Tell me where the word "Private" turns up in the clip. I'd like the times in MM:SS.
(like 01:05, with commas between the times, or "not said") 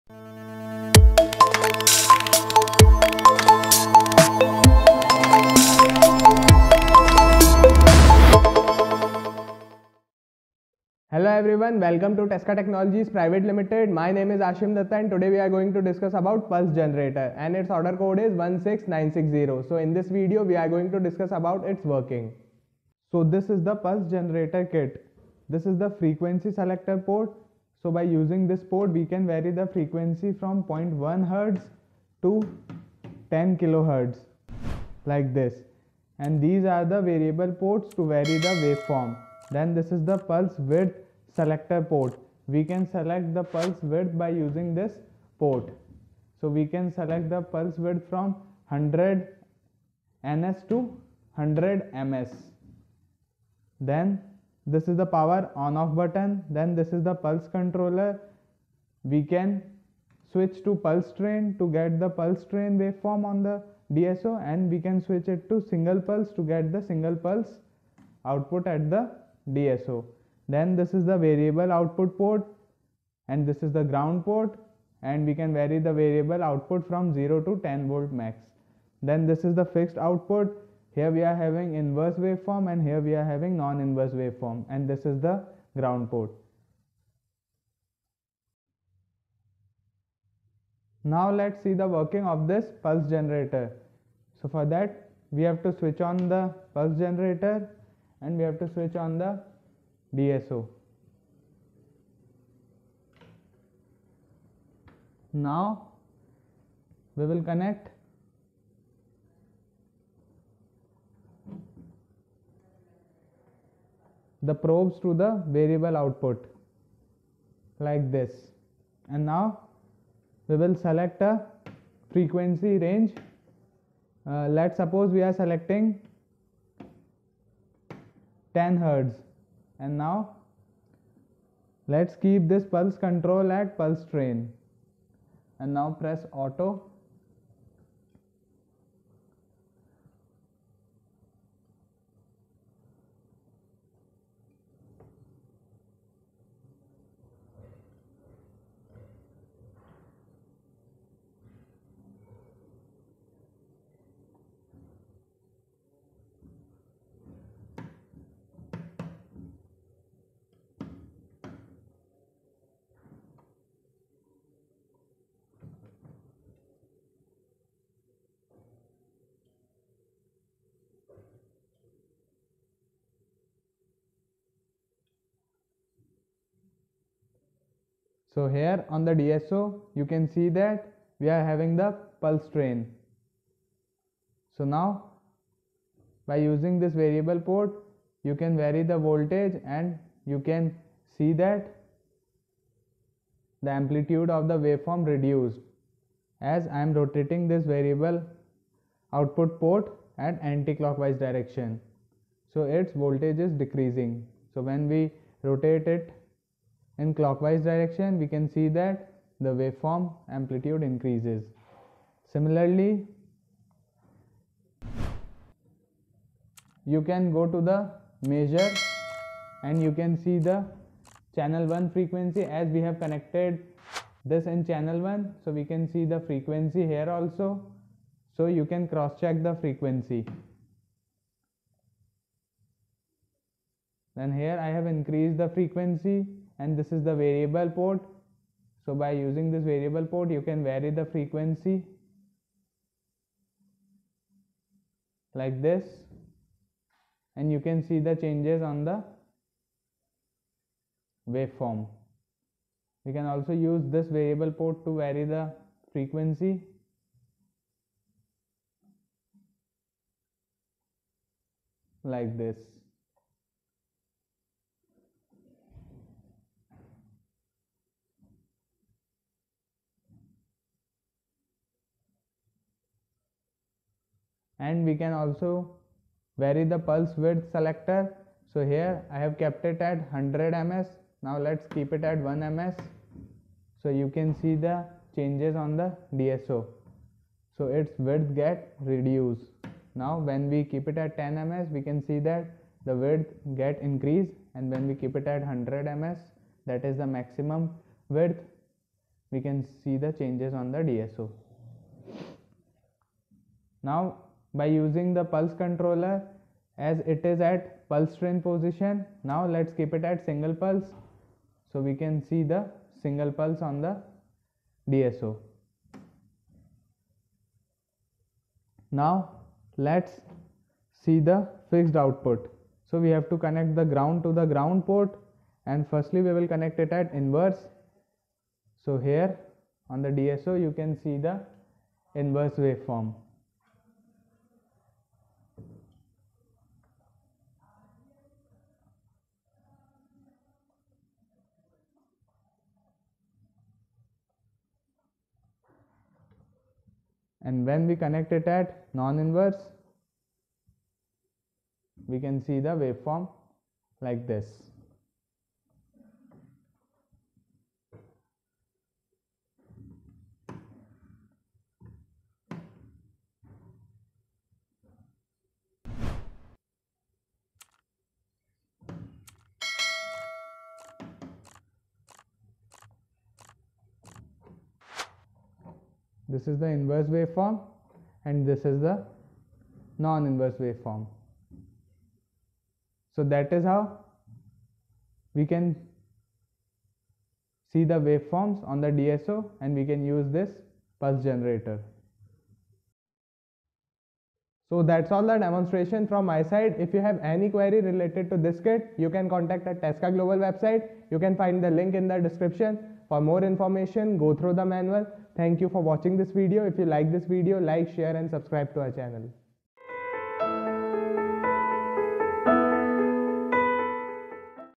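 00:13.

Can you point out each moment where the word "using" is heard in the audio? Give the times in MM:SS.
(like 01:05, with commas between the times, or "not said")
00:28, 00:44, 03:06, 03:59, 05:04.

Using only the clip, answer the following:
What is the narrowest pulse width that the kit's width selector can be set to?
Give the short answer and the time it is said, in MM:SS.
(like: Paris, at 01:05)
100 ns, at 00:48.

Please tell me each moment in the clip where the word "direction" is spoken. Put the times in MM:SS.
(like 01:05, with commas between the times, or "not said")
03:21, 03:27.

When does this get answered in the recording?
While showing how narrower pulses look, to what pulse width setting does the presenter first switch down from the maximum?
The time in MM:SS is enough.
04:42.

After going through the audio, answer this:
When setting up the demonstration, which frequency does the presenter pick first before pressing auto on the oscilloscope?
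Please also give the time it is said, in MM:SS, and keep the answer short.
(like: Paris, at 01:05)
10 hertz, at 02:08.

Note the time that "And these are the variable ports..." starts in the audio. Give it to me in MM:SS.
00:36.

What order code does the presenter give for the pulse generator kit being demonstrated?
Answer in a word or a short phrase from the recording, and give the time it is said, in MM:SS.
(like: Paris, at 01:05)
16960, at 00:18.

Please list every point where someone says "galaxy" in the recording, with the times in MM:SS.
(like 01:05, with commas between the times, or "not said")
not said.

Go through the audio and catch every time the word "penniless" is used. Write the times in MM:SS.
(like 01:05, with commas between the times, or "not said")
not said.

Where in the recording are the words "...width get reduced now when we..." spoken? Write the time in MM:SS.
04:47.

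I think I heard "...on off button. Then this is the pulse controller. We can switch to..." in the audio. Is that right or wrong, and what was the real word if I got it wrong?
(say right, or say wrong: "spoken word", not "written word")
right.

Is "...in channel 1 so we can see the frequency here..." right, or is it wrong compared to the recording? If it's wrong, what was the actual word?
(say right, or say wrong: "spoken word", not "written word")
right.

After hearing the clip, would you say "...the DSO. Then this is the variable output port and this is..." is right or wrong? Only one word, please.
right.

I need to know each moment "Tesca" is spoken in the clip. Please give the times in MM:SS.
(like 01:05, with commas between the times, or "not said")
00:12, 06:39.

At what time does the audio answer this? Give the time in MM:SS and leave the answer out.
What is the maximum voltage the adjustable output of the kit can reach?
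01:17.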